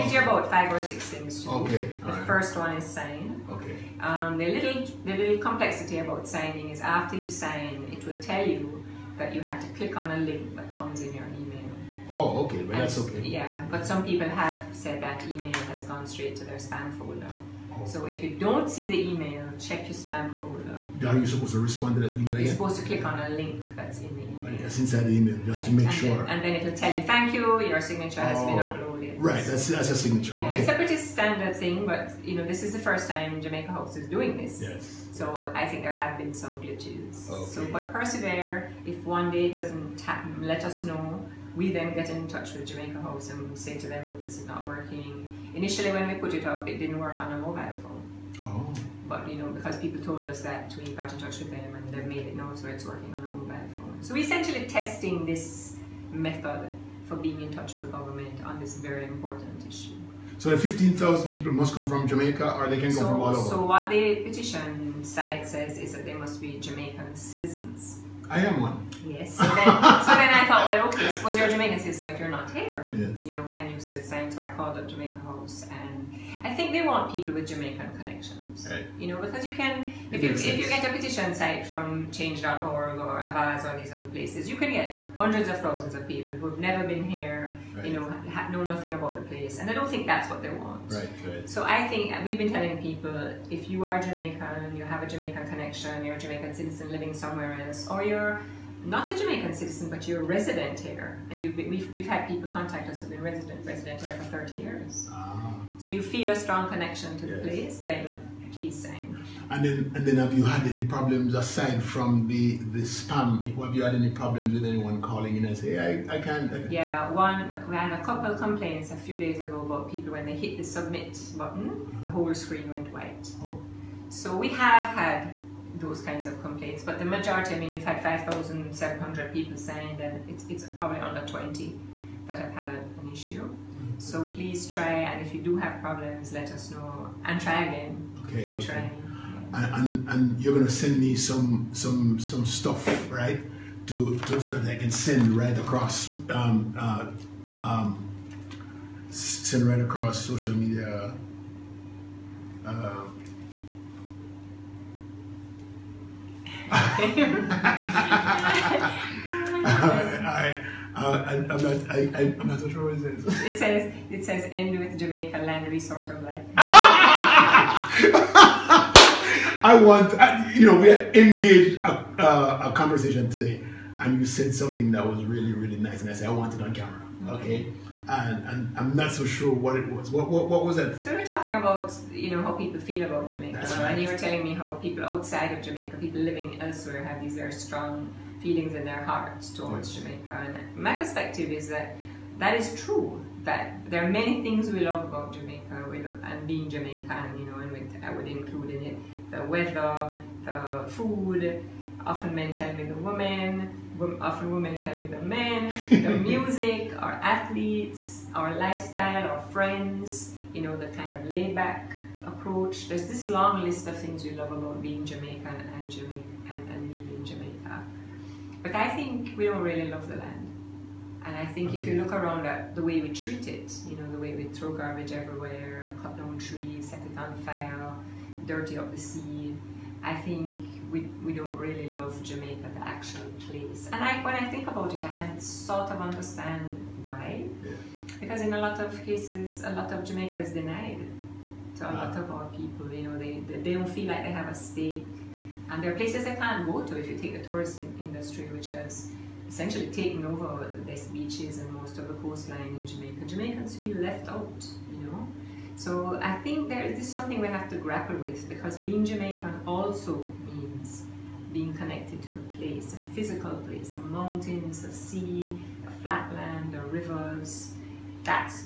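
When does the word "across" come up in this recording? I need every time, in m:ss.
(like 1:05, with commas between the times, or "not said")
2:25, 2:29.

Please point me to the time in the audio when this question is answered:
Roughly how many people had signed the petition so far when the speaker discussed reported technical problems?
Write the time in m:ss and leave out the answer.
2:08.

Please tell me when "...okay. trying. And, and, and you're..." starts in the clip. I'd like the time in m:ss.
2:18.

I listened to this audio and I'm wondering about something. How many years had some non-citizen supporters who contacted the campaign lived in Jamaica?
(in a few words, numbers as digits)
30 years.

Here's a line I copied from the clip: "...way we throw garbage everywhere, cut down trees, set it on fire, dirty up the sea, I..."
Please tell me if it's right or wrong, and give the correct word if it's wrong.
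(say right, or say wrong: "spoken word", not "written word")
right.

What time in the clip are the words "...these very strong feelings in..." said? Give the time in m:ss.
3:07.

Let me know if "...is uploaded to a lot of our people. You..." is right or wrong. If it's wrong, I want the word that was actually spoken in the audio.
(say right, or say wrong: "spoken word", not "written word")
wrong: "denied", not "uploaded".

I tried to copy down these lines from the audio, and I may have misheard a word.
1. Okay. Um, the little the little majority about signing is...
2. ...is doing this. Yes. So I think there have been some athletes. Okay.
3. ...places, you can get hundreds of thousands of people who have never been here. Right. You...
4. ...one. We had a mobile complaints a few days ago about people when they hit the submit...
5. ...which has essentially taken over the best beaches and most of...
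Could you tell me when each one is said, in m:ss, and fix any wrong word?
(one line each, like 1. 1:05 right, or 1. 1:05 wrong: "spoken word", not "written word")
1. 0:03 wrong: "complexity", not "majority"
2. 0:33 wrong: "glitches", not "athletes"
3. 1:24 right
4. 1:57 wrong: "couple", not "mobile"
5. 4:08 right.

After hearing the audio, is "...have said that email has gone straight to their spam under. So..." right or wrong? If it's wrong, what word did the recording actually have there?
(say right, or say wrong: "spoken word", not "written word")
wrong: "folder", not "under".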